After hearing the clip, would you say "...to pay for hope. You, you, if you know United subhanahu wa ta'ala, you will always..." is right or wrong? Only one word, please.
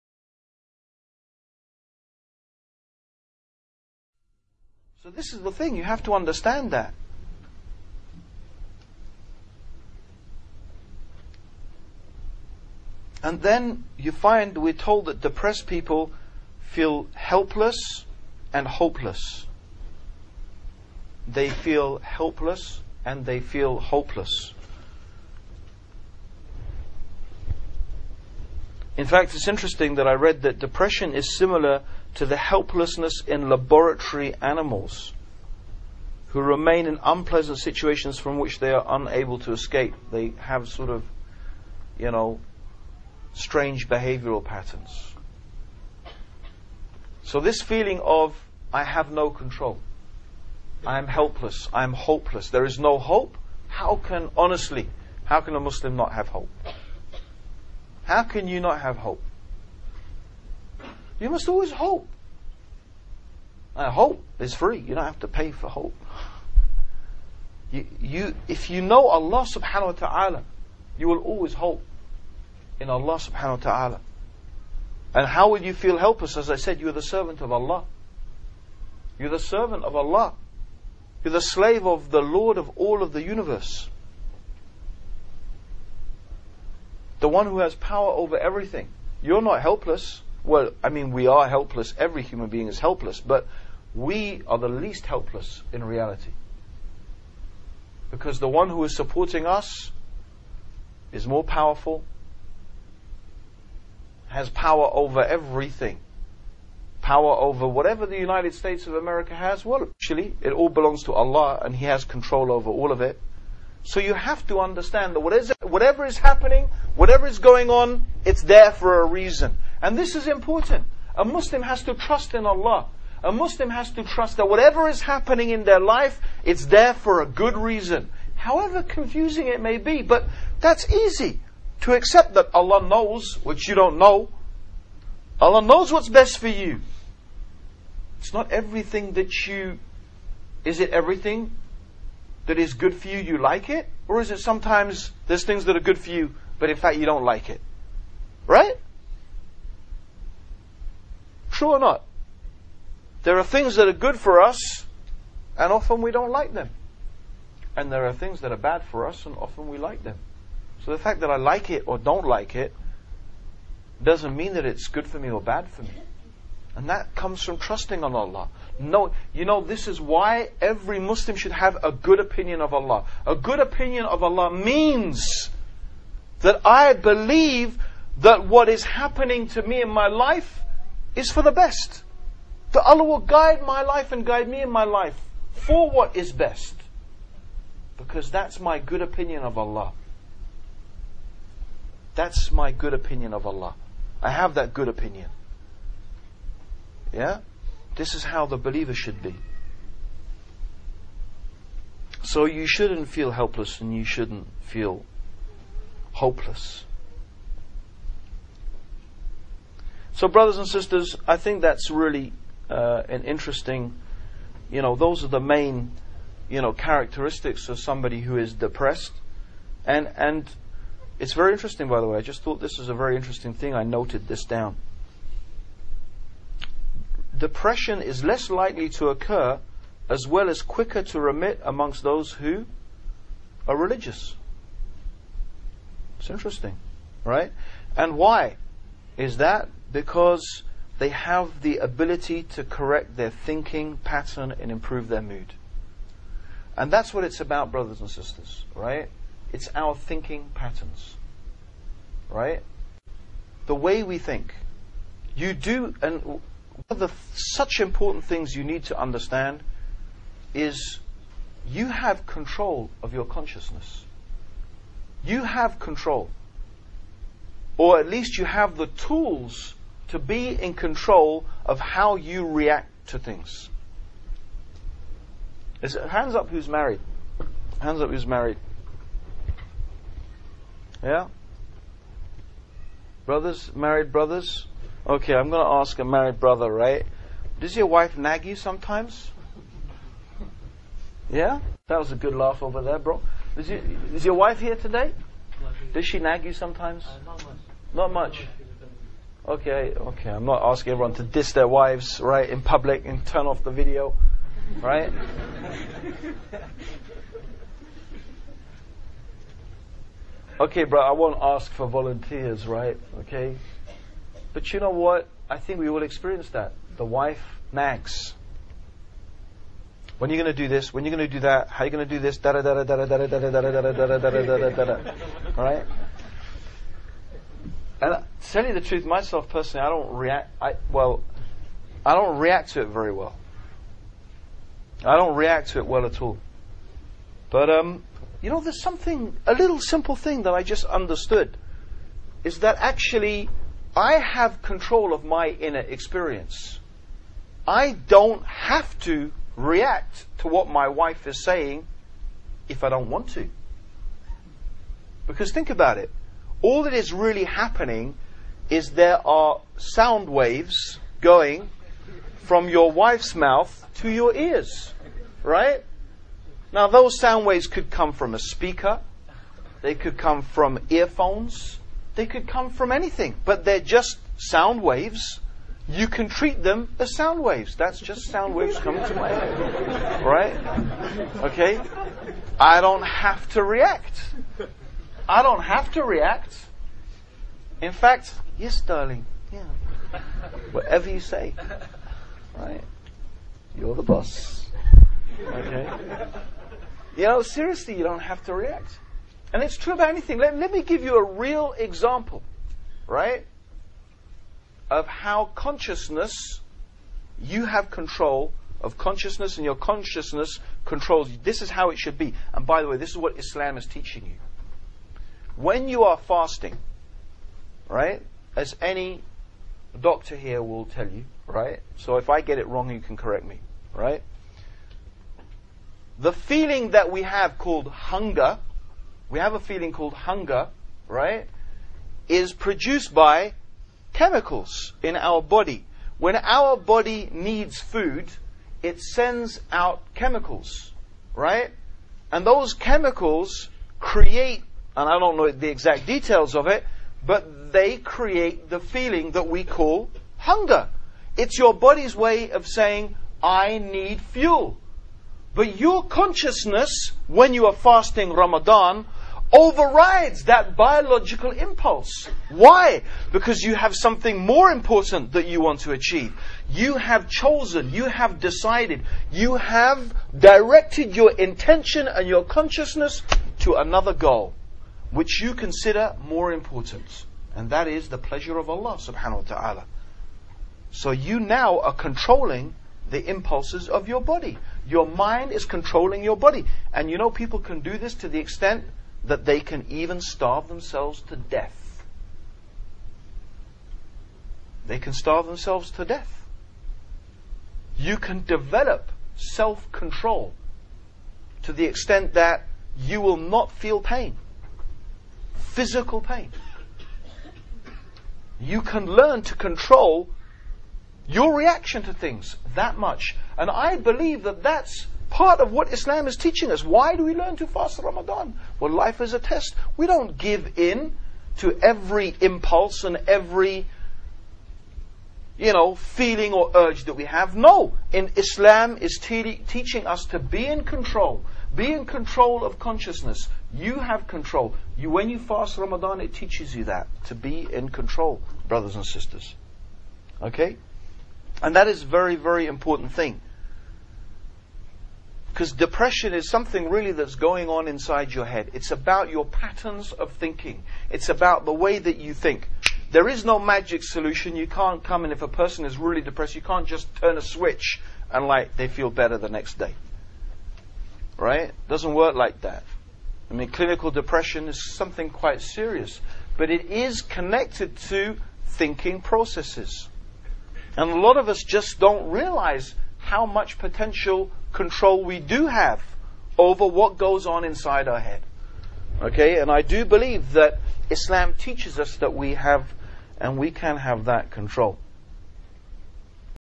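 wrong.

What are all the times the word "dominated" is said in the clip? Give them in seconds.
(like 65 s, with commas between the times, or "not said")
not said.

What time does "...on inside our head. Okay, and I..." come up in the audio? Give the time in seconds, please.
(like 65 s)
577 s.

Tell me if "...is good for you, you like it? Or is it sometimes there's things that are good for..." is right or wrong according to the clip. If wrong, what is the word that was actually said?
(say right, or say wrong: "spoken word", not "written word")
right.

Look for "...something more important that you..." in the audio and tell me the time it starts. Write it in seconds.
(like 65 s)
463 s.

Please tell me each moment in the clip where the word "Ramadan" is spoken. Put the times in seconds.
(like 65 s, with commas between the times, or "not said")
458 s, 518 s, 535 s.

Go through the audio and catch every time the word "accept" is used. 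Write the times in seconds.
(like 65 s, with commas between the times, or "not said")
131 s.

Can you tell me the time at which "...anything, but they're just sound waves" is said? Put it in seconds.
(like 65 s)
372 s.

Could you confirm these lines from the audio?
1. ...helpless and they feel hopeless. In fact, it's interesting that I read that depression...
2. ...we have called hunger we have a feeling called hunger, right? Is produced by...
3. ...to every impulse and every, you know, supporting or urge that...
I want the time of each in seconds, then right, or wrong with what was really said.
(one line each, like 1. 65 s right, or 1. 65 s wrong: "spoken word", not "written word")
1. 21 s right
2. 427 s right
3. 521 s wrong: "feeling", not "supporting".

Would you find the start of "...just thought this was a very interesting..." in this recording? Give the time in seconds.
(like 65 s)
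222 s.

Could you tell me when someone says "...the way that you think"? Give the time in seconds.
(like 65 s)
551 s.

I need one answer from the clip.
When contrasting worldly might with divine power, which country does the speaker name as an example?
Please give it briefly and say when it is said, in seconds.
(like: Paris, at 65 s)
United States of America, at 108 s.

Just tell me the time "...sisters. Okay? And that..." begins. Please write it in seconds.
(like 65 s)
539 s.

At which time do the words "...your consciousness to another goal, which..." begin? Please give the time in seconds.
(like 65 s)
472 s.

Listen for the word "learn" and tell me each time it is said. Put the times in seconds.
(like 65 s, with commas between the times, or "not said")
509 s, 517 s.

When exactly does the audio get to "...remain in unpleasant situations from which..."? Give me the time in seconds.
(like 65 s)
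36 s.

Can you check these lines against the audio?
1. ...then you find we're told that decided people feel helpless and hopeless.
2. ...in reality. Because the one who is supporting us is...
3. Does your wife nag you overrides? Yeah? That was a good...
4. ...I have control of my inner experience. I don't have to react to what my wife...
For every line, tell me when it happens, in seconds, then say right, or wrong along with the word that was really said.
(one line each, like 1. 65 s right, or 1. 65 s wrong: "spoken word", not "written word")
1. 13 s wrong: "depressed", not "decided"
2. 95 s right
3. 287 s wrong: "sometimes", not "overrides"
4. 343 s right.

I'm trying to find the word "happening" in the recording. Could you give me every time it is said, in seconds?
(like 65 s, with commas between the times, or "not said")
116 s, 125 s, 178 s, 357 s.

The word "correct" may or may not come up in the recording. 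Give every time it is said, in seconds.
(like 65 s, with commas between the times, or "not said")
242 s, 423 s.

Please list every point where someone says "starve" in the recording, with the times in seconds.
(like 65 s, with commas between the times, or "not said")
490 s, 495 s.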